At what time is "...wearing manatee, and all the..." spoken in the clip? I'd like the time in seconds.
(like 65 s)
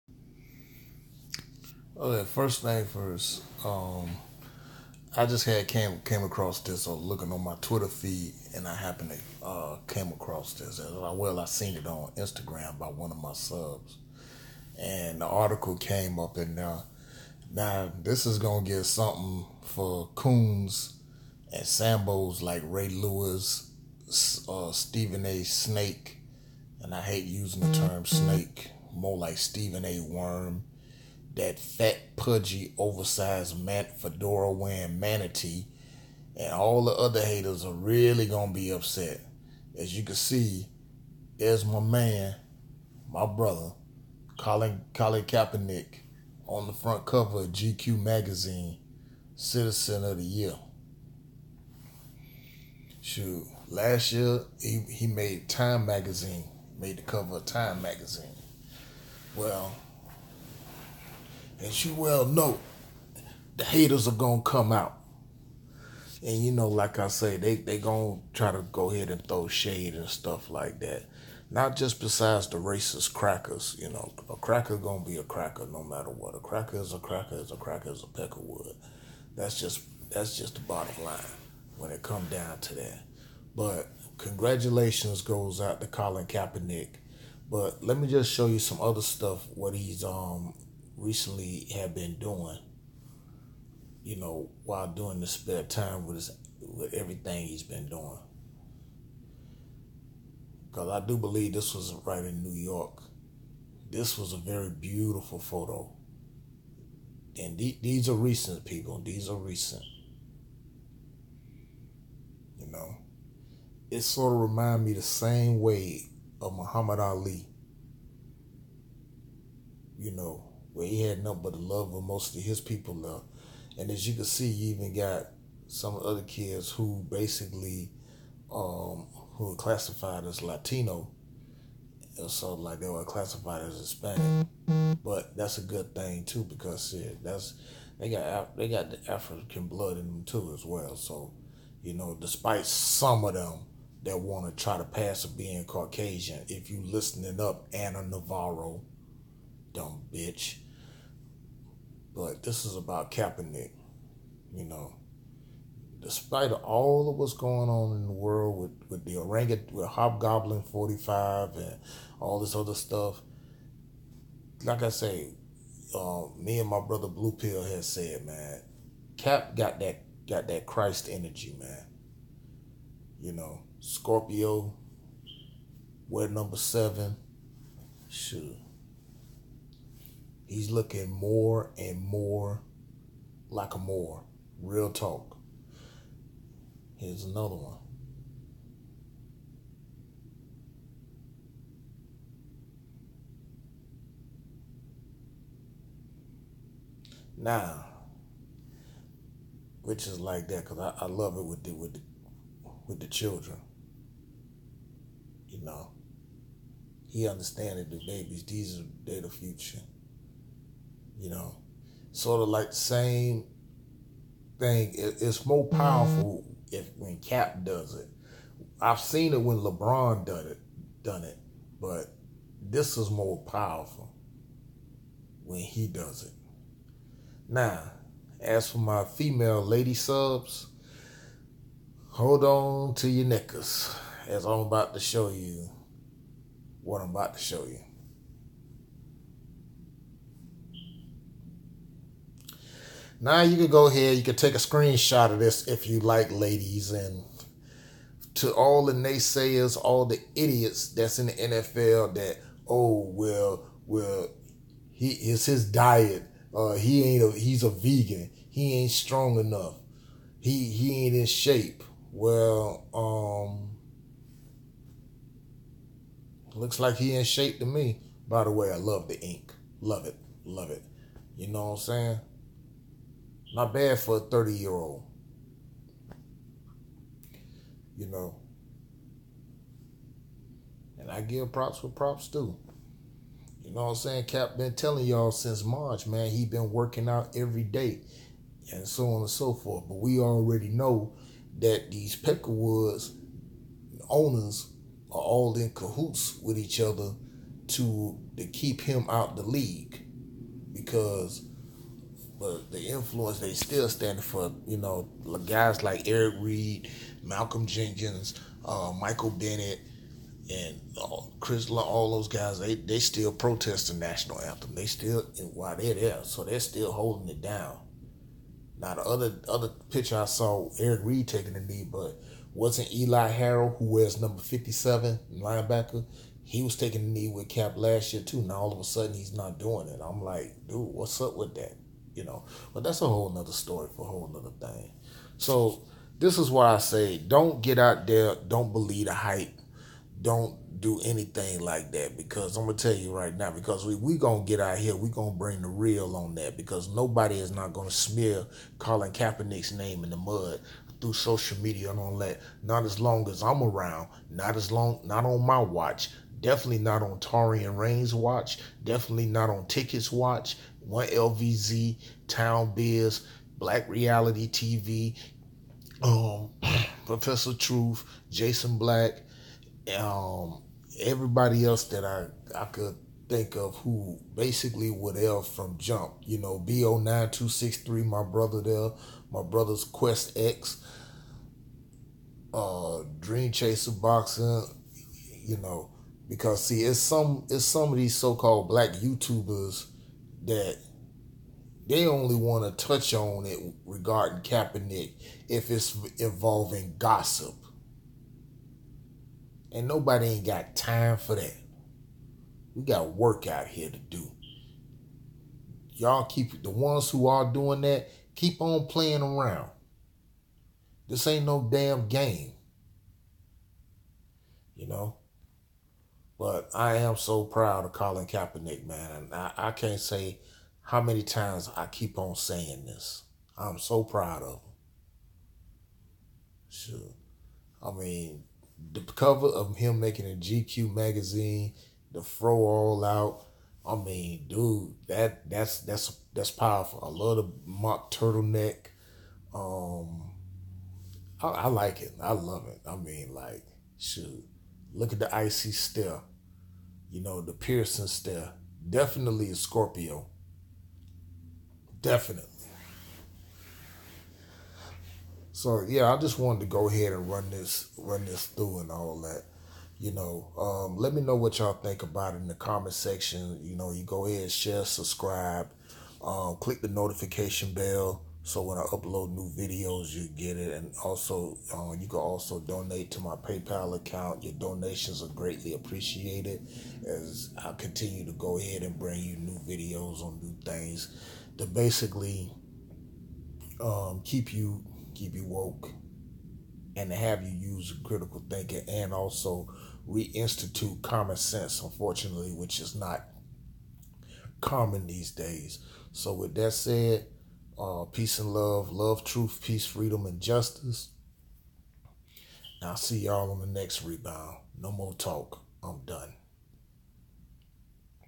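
34 s.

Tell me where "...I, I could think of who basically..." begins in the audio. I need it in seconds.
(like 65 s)
372 s.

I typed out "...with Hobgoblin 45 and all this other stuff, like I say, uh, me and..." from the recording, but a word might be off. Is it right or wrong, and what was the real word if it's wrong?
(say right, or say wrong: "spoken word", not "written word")
right.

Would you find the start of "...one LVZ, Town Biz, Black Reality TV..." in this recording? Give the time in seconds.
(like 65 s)
360 s.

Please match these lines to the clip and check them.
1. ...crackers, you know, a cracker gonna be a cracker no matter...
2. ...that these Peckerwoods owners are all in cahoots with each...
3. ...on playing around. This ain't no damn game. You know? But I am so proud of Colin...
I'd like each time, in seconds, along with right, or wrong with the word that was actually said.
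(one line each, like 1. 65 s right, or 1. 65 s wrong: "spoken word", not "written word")
1. 73 s right
2. 291 s right
3. 408 s right.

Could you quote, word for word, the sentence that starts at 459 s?
You know, um, let me know what y'all think about it in the comment section.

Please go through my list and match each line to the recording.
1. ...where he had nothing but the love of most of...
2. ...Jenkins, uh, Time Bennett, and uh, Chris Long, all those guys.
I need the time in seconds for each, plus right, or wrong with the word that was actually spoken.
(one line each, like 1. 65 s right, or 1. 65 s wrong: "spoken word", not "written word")
1. 120 s right
2. 307 s wrong: "Michael", not "Time".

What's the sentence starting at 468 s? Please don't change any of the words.
So when I upload new videos, you get it.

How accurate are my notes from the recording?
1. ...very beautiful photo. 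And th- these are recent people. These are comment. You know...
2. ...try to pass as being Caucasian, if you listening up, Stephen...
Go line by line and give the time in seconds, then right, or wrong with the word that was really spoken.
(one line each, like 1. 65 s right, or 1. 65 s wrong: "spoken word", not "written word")
1. 104 s wrong: "recent", not "comment"
2. 144 s wrong: "Ana", not "Stephen".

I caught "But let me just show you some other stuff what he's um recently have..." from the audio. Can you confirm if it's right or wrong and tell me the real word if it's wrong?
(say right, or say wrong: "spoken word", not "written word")
right.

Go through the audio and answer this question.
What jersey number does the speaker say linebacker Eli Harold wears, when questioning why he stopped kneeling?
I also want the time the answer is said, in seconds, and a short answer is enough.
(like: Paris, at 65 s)
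57, at 324 s.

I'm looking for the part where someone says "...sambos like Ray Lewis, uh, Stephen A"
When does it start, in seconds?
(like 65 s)
21 s.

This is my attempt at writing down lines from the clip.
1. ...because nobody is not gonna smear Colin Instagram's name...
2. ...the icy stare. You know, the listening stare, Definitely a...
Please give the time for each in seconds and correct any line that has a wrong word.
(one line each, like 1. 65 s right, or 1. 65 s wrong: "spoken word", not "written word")
1. 346 s wrong: "Kaepernick", not "Instagram"
2. 445 s wrong: "piercing", not "listening".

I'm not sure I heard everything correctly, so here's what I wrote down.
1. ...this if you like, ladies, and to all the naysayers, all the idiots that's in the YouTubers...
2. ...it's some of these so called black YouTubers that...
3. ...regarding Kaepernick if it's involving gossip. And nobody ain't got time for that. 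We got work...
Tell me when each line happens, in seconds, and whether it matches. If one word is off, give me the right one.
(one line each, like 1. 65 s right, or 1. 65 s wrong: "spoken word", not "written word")
1. 245 s wrong: "NFL", not "YouTubers"
2. 387 s right
3. 393 s right.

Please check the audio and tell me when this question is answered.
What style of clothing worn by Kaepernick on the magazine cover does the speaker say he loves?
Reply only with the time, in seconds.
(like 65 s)
437 s.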